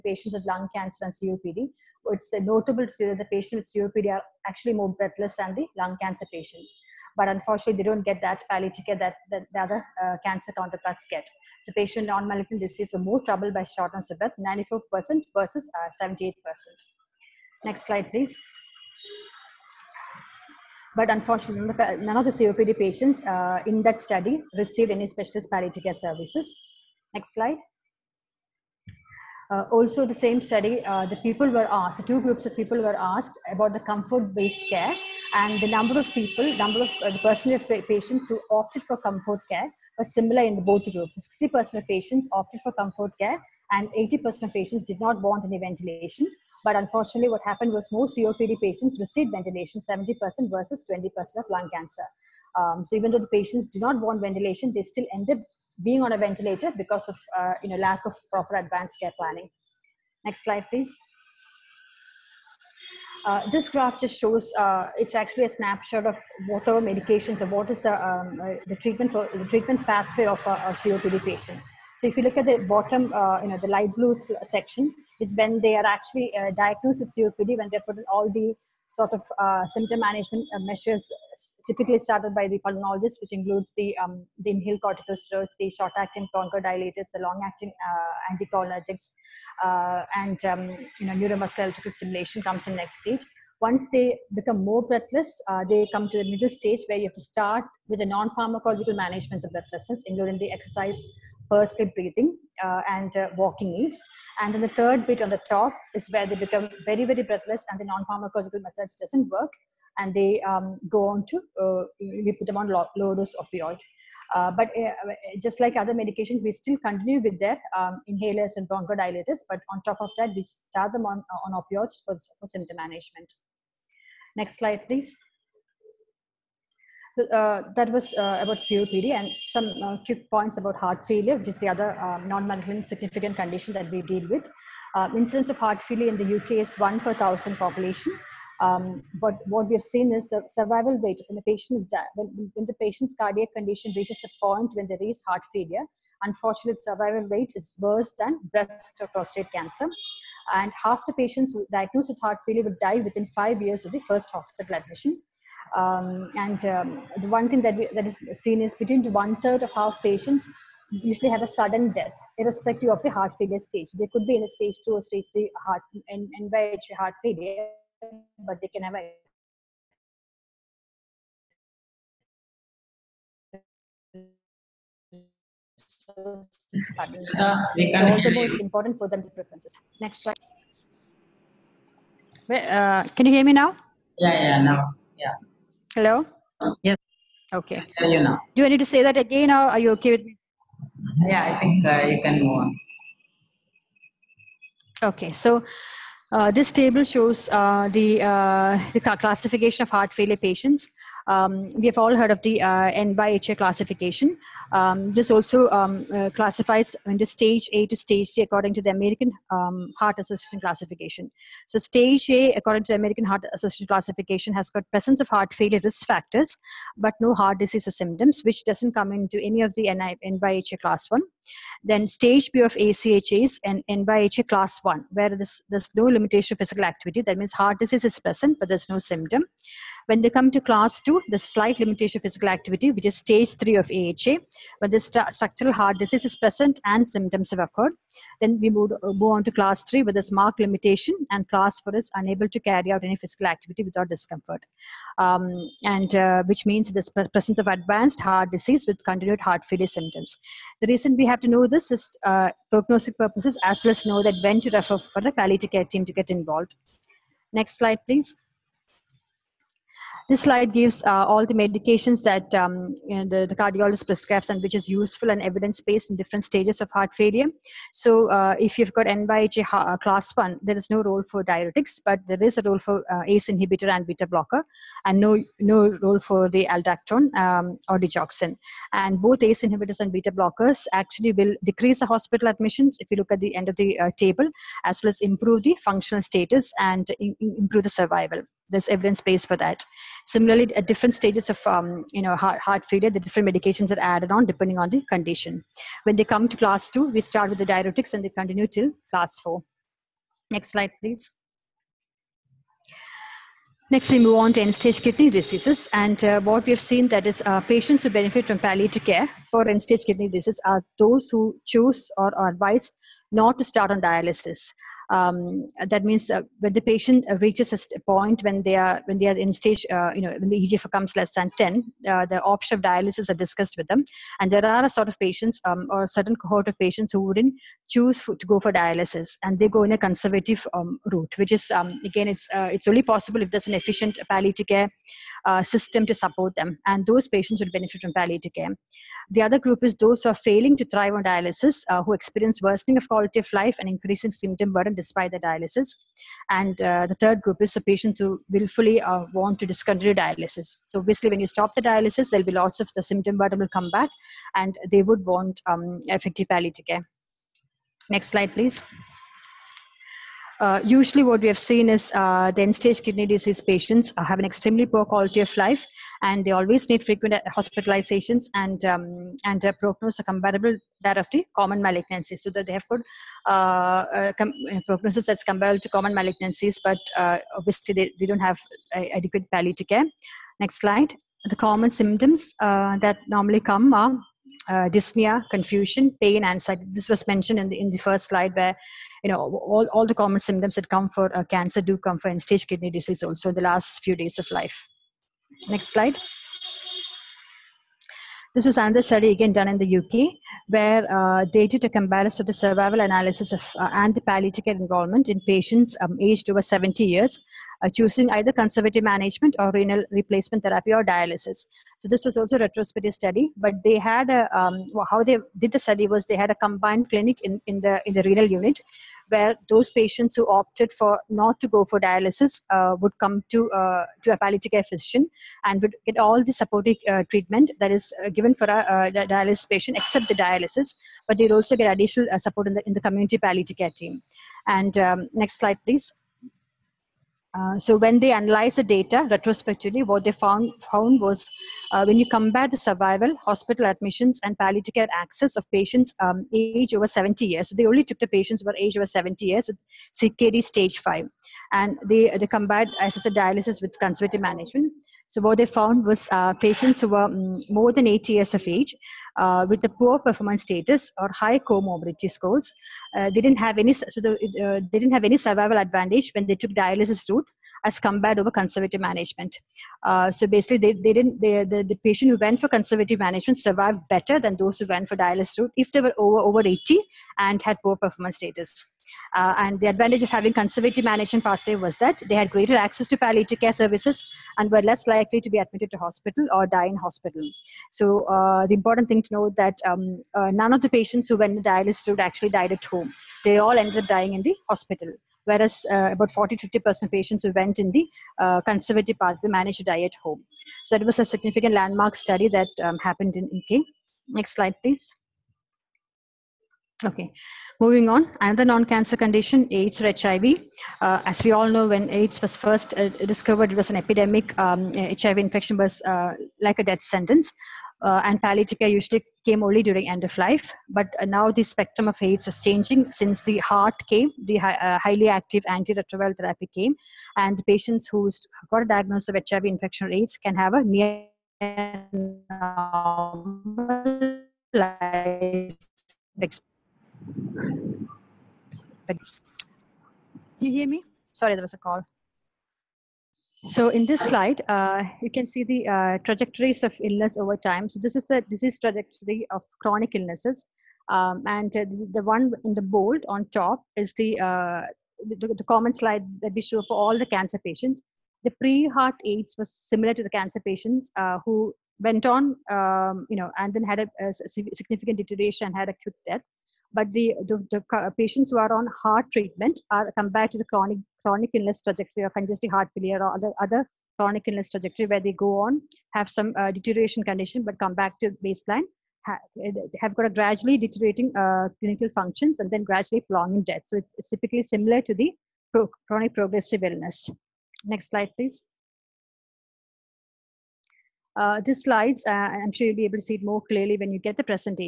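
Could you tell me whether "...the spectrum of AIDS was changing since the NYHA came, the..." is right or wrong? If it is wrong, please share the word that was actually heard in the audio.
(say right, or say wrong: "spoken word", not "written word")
wrong: "HAART", not "NYHA".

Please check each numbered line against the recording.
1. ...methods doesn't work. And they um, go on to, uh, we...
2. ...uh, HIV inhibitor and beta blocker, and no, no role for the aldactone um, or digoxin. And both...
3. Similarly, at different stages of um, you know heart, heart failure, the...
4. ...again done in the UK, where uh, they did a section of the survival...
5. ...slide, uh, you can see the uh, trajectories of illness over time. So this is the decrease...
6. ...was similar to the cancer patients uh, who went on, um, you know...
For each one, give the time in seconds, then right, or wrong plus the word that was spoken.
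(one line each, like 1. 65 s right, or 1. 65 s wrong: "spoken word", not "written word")
1. 108 s right
2. 273 s wrong: "ACE", not "HIV"
3. 290 s right
4. 399 s wrong: "comparison", not "section"
5. 544 s wrong: "disease", not "decrease"
6. 559 s right.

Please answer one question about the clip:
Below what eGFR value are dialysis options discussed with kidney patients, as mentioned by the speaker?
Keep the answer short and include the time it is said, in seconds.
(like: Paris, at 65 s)
10, at 321 s.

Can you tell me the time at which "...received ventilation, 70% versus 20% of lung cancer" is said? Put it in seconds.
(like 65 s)
48 s.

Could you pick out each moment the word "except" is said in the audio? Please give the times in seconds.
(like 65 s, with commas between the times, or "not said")
429 s.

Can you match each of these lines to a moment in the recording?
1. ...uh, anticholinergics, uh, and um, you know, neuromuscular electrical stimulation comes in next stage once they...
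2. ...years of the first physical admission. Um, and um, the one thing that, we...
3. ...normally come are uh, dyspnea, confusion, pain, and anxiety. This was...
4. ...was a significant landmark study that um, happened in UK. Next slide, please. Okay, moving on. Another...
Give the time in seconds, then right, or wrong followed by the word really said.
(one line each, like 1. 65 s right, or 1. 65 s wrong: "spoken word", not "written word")
1. 87 s right
2. 153 s wrong: "hospital", not "physical"
3. 383 s right
4. 501 s right.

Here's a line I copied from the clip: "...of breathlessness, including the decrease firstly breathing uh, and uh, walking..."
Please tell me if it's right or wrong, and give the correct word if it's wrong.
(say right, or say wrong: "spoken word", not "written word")
wrong: "exercise", not "decrease".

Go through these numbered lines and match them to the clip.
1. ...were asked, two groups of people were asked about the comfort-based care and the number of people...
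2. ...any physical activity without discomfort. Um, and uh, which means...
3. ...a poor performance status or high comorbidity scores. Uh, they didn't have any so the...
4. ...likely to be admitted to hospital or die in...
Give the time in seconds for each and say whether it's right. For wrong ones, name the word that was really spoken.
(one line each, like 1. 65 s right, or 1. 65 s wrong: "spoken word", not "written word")
1. 31 s right
2. 243 s right
3. 459 s right
4. 485 s right.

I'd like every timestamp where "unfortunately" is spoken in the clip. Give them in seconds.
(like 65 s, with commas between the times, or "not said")
7 s, 21 s, 46 s, 146 s.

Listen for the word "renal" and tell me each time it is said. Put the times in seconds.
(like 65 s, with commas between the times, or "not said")
409 s, 418 s.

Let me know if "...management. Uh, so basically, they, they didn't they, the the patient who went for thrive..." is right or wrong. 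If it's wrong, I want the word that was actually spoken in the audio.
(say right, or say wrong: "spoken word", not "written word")
wrong: "conservative", not "thrive".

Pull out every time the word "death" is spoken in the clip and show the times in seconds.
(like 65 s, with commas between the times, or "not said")
161 s, 516 s, 566 s, 583 s.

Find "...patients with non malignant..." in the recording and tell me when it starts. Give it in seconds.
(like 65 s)
11 s.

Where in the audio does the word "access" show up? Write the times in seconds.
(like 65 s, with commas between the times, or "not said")
445 s, 482 s.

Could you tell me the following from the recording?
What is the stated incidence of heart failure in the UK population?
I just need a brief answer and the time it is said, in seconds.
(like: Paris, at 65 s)
1 per 1000, at 136 s.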